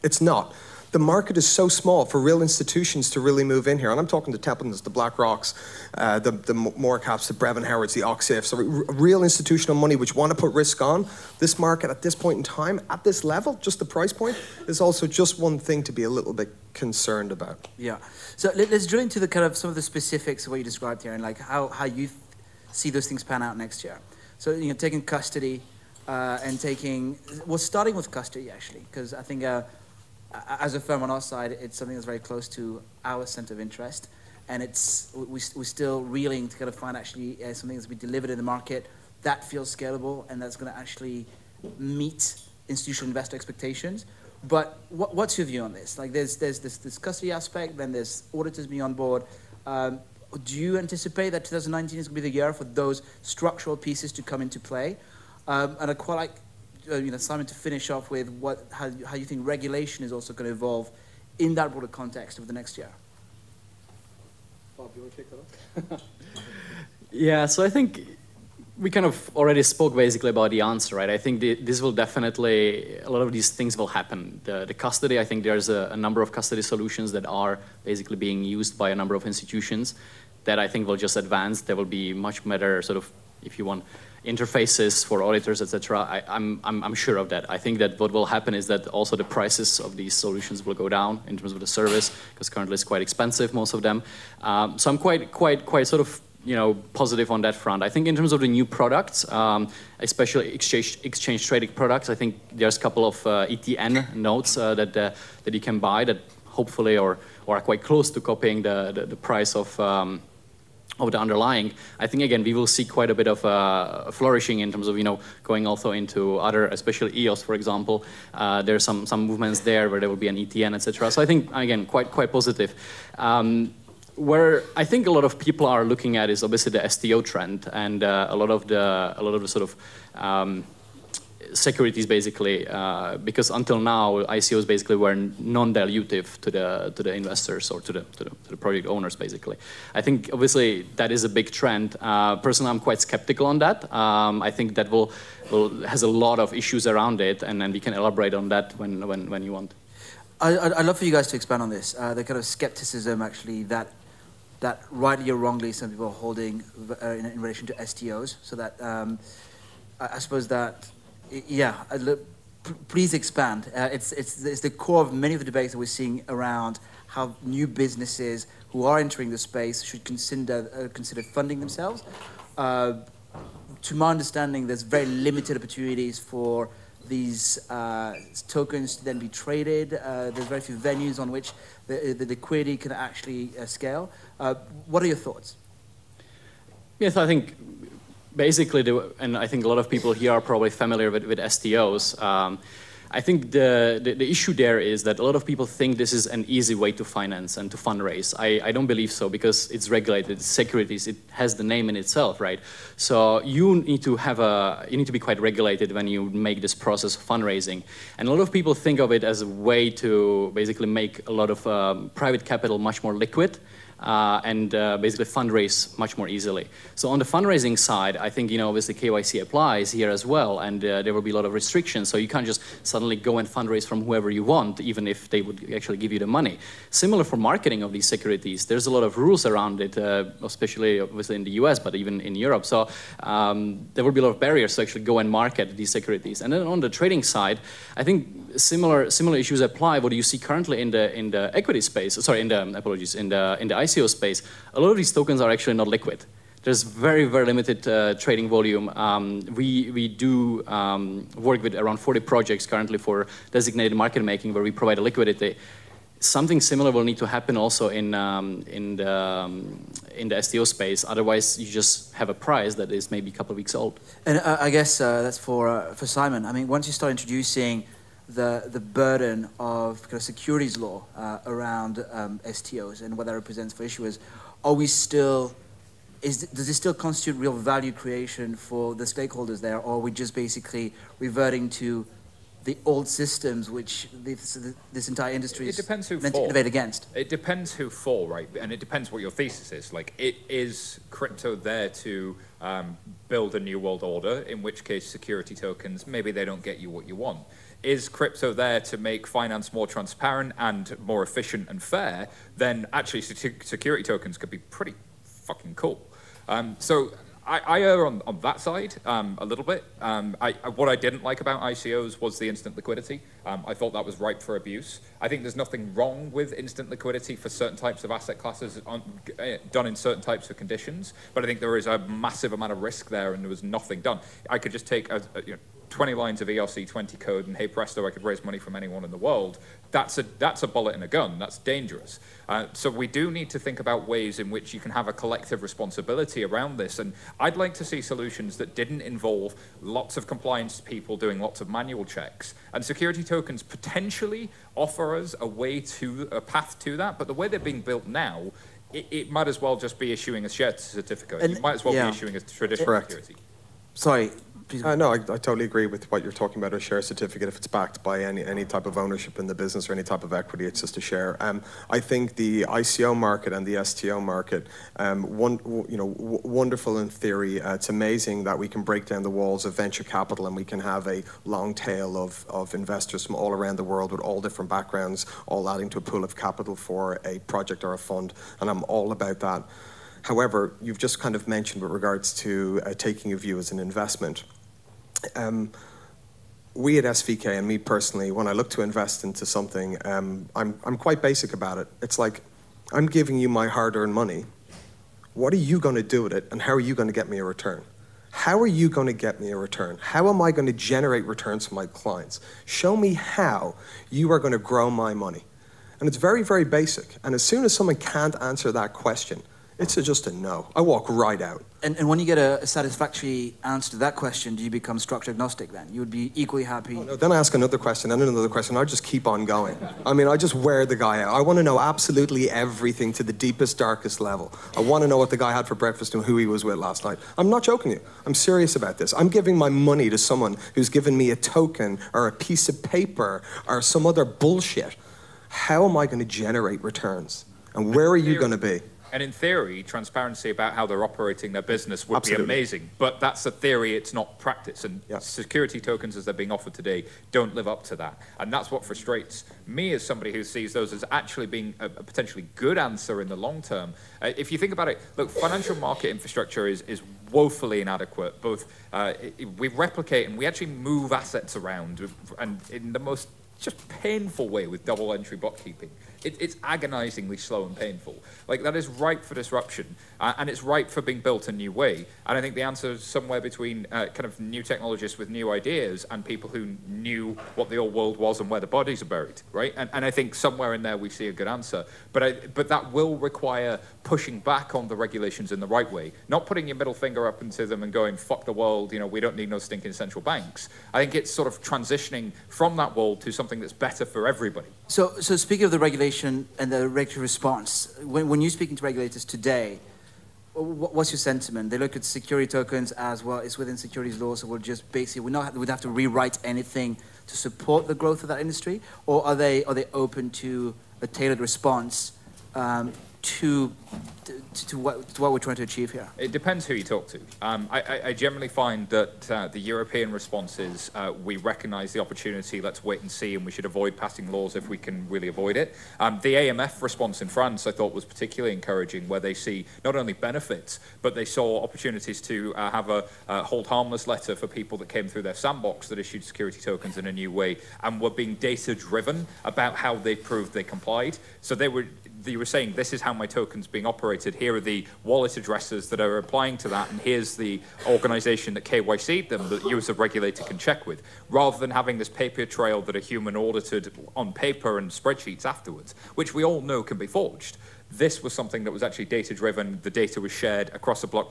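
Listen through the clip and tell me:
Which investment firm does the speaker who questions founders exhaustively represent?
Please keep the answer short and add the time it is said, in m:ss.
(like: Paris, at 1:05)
SVK, at 6:27.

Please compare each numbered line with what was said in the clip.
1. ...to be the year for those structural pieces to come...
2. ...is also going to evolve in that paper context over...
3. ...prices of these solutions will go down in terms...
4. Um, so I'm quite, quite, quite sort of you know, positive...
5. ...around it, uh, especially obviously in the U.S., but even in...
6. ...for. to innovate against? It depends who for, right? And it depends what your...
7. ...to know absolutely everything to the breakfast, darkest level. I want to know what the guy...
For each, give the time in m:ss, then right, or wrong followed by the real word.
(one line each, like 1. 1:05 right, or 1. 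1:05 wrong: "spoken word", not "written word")
1. 0:52 right
2. 1:00 wrong: "broader", not "paper"
3. 1:29 right
4. 1:34 right
5. 3:49 right
6. 4:46 right
7. 7:01 wrong: "deepest", not "breakfast".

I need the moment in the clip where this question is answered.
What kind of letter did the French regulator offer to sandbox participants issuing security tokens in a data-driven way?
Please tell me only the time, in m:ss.
8:53.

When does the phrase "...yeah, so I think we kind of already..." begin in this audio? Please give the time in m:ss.
1:07.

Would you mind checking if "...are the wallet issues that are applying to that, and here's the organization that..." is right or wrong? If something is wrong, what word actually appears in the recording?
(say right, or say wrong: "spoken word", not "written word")
wrong: "addresses", not "issues".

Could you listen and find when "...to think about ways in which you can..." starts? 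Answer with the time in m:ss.
5:33.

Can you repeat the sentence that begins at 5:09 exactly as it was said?
Um, I, what I didn't like about ICOs was the instant liquidity.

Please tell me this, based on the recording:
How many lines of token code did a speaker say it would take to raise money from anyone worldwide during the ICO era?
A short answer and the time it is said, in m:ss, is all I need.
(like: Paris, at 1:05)
20, at 5:25.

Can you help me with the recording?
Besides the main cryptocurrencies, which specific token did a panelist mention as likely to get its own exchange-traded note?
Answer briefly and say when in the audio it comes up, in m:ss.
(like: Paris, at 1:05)
EOS, at 1:57.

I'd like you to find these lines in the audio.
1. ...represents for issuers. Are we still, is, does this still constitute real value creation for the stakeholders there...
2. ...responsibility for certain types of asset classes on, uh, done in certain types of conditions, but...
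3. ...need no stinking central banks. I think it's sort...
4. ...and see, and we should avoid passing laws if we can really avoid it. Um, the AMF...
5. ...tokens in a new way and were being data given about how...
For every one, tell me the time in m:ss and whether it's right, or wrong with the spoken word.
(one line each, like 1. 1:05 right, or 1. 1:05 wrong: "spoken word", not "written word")
1. 4:33 right
2. 5:16 wrong: "liquidity", not "responsibility"
3. 8:09 right
4. 8:42 right
5. 8:56 wrong: "driven", not "given".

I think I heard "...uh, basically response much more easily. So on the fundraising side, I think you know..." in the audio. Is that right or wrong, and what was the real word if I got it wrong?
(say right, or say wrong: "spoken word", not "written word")
wrong: "fundraise", not "response".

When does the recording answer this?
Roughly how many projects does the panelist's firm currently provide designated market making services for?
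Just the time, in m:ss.
4:11.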